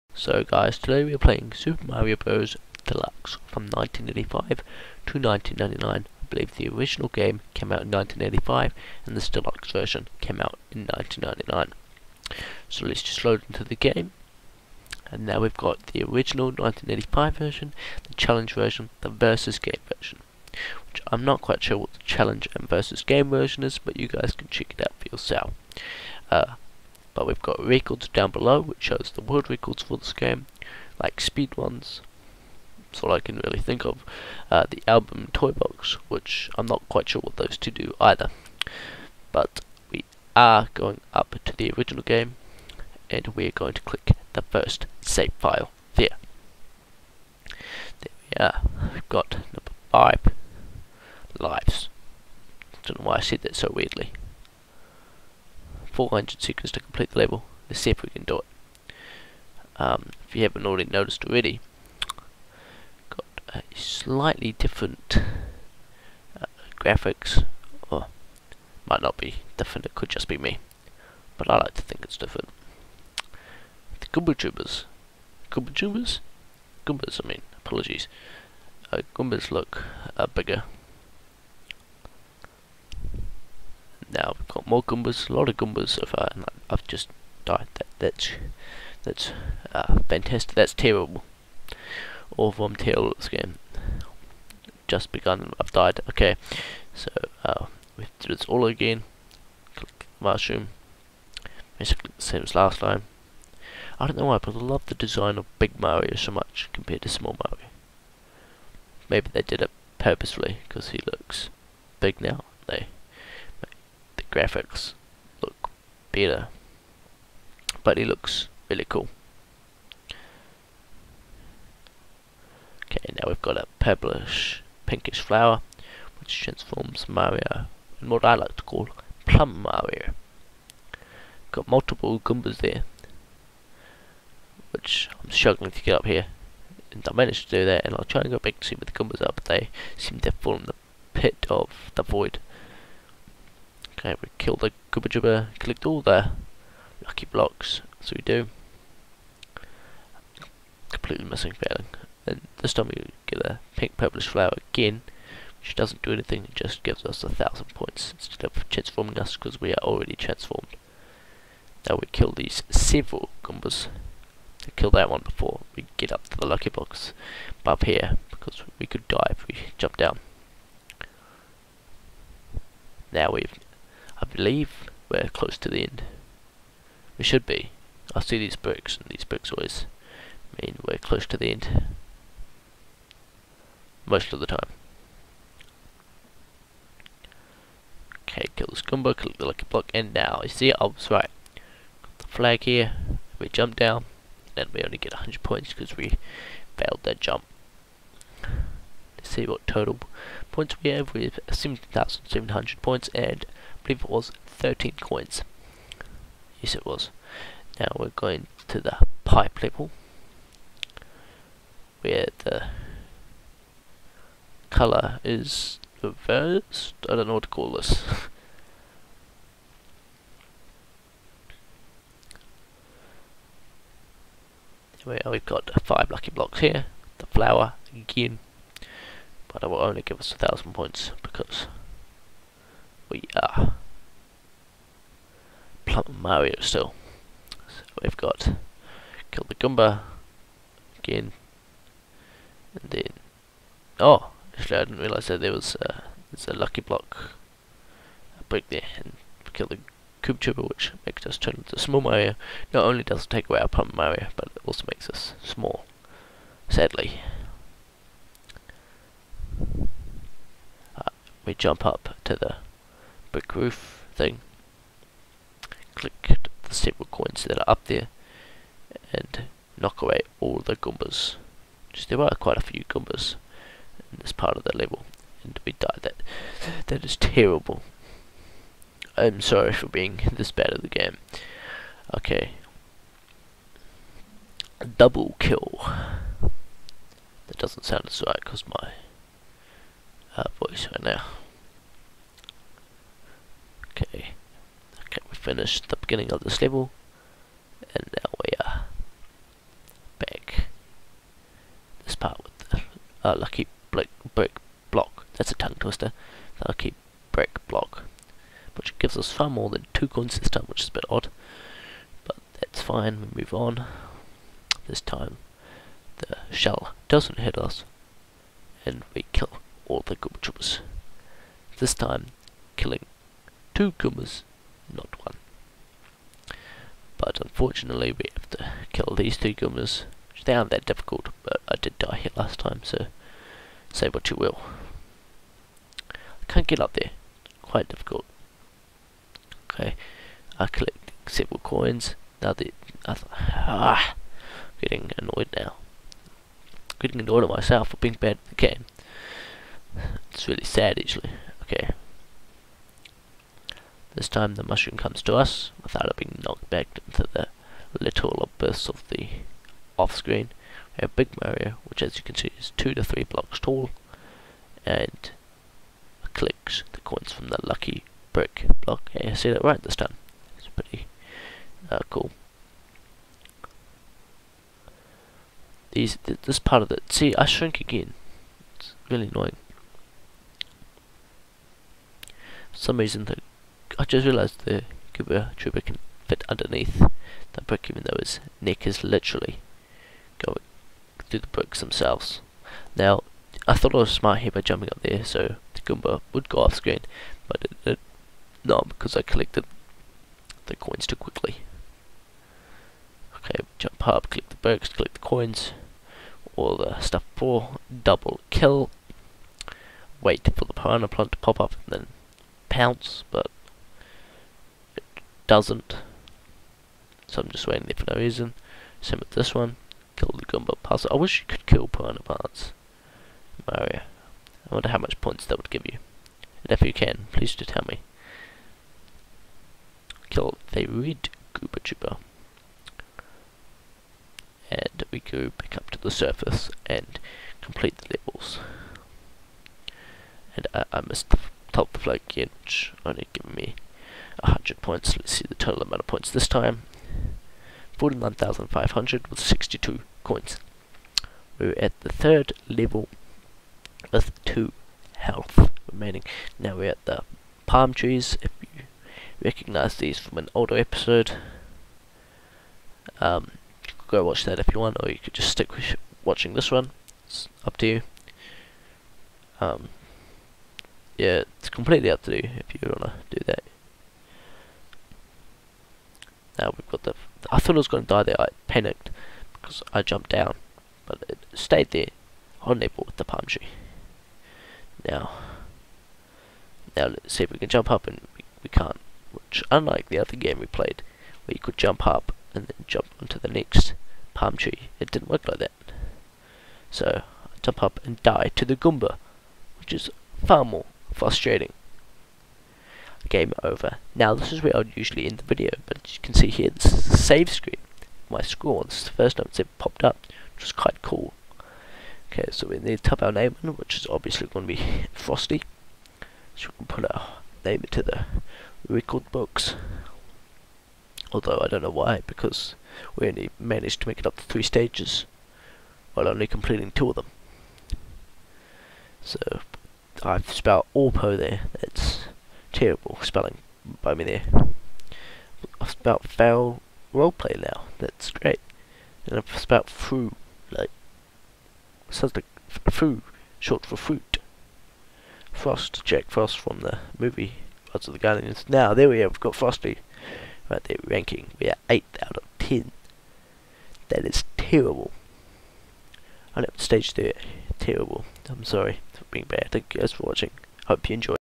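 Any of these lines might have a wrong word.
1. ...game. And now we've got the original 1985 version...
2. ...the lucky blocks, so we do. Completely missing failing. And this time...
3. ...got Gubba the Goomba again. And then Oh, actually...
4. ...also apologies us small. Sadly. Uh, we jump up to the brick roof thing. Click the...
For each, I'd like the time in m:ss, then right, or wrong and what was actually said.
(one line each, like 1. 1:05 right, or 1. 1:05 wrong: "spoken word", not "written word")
1. 0:13 right
2. 2:26 right
3. 3:58 wrong: "Kill", not "Gubba"
4. 4:14 wrong: "makes", not "apologies".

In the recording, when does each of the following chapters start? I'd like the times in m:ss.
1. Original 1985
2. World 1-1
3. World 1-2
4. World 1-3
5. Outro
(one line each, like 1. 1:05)
1. 0:14
2. 0:47
3. 3:22
4. 7:30
5. 8:20.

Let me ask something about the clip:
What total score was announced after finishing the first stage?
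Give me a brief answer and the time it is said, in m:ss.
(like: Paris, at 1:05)
17,700, at 3:21.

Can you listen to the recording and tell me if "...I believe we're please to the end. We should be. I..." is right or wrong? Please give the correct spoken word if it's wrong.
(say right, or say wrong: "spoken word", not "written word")
wrong: "close", not "please".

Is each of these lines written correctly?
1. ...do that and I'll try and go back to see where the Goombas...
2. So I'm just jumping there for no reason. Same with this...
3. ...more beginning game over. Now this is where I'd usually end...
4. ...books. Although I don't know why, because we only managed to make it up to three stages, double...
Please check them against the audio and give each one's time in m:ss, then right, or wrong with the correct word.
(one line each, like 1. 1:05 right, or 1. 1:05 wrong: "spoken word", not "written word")
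1. 2:17 right
2. 6:57 wrong: "waiting", not "jumping"
3. 8:20 wrong: "frustrating", not "beginning"
4. 8:39 wrong: "while", not "double".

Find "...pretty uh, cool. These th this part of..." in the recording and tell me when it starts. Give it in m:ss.
6:10.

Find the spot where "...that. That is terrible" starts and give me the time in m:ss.
4:36.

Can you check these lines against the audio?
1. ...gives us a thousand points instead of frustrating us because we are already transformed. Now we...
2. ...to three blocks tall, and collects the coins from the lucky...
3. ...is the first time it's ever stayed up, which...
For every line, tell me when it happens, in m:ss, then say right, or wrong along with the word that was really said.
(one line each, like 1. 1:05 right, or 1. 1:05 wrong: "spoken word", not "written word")
1. 2:36 wrong: "transforming", not "frustrating"
2. 6:02 right
3. 8:28 wrong: "popped", not "stayed".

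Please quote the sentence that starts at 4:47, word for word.
That doesn't sound as right because my uh, voice right now.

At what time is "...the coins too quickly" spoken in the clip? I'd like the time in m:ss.
6:40.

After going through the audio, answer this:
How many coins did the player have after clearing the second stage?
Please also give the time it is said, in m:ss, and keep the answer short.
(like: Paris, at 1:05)
62, at 7:29.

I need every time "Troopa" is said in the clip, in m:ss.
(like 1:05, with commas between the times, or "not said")
4:10, 6:25.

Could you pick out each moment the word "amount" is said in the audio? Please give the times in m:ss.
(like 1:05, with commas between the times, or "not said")
7:25.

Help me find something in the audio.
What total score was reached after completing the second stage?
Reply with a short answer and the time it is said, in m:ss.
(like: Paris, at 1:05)
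49,500, at 7:27.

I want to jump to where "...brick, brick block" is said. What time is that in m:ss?
5:03.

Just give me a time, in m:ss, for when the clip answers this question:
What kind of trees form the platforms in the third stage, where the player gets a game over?
7:37.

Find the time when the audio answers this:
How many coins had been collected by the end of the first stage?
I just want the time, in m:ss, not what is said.
3:24.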